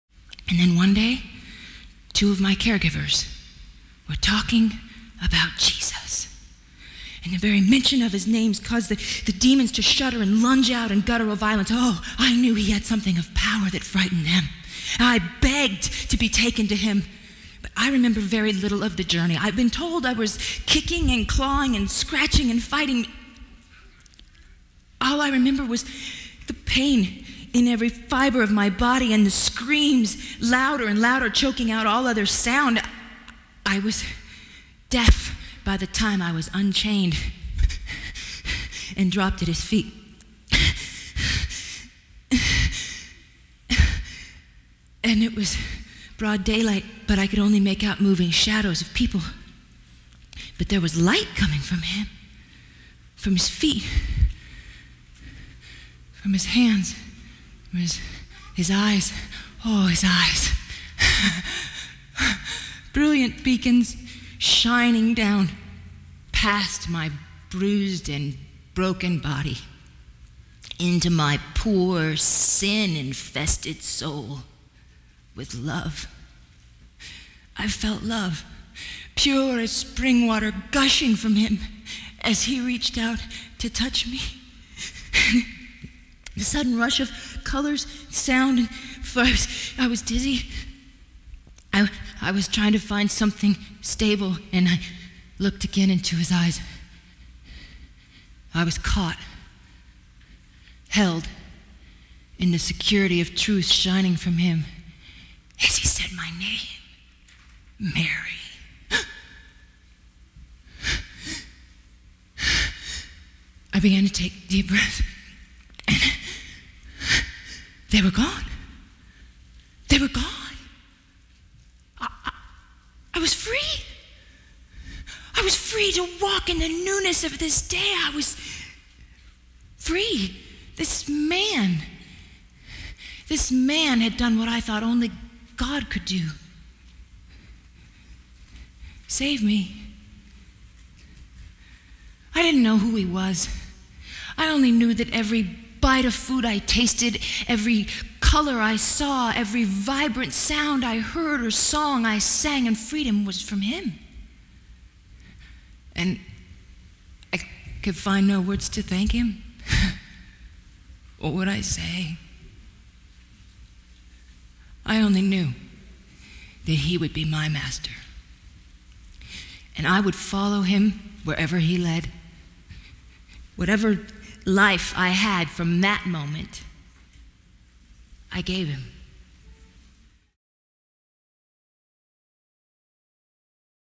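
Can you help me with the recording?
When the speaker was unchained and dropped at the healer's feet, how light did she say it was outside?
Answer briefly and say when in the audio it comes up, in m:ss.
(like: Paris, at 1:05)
Broad daylight, at 0:46.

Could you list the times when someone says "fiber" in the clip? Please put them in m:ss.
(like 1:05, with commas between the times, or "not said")
0:27.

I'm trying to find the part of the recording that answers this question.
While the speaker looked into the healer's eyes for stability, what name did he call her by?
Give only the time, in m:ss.
1:47.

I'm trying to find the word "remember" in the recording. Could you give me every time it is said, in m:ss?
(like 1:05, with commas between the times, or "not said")
0:17, 0:25.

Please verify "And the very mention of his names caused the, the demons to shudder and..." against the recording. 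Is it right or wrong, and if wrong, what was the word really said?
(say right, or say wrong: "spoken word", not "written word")
right.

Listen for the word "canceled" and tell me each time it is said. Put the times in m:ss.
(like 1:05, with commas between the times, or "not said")
not said.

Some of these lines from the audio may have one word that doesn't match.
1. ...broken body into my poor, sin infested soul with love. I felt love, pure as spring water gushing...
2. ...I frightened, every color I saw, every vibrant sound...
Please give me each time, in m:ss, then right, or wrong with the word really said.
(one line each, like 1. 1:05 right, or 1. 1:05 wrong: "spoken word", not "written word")
1. 1:08 right
2. 2:26 wrong: "tasted", not "frightened".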